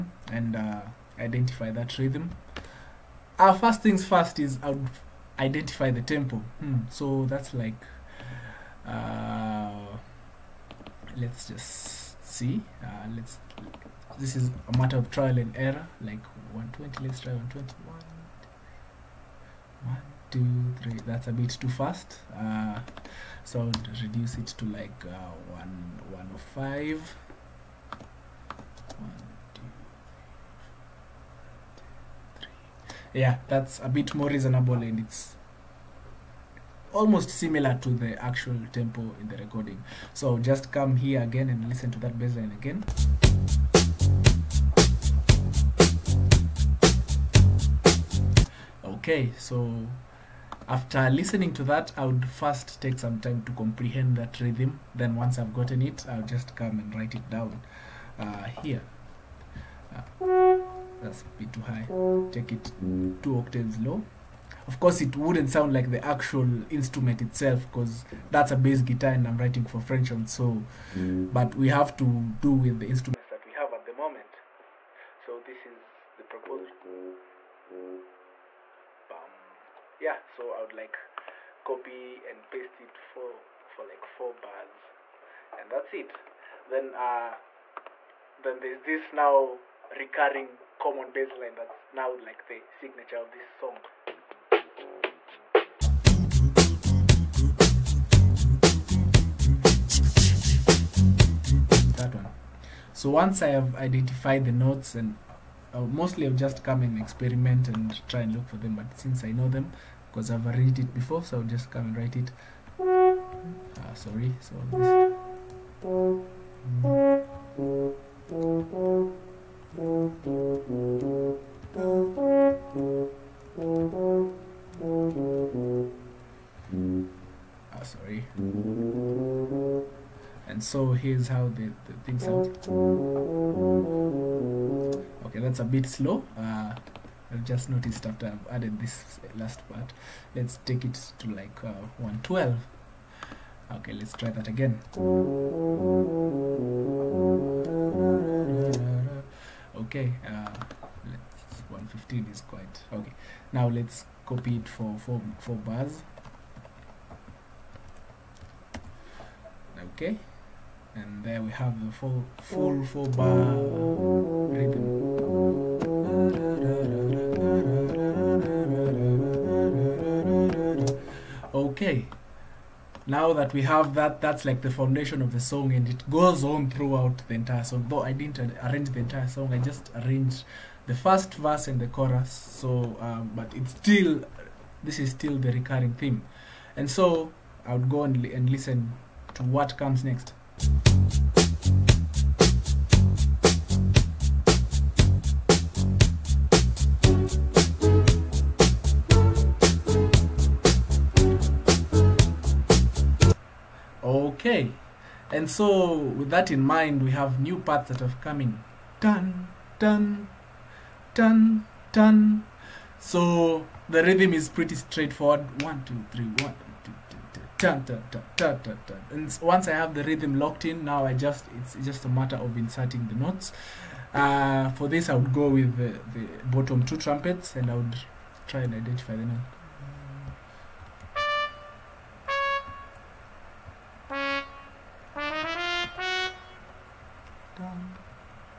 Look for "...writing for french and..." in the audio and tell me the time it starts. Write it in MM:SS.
01:09.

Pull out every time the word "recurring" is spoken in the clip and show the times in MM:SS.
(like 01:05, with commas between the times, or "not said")
01:29, 03:05.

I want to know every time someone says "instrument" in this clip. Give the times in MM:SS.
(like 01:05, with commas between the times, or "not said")
01:06, 01:12.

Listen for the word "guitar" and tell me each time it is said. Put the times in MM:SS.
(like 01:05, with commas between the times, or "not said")
01:08.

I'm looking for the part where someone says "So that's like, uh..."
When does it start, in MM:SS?
00:06.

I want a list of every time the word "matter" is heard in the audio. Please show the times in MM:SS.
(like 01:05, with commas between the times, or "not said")
00:14, 03:42.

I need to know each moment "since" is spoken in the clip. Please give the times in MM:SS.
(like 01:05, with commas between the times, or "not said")
01:48.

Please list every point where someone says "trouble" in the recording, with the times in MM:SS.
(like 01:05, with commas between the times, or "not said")
not said.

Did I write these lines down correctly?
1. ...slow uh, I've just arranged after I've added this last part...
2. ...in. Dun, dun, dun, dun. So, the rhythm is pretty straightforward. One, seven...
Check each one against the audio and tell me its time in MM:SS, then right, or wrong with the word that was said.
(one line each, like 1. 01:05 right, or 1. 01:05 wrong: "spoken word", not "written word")
1. 02:15 wrong: "noticed", not "arranged"
2. 03:28 wrong: "two", not "seven".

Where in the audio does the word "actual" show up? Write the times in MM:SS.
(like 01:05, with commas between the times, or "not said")
00:38, 01:06.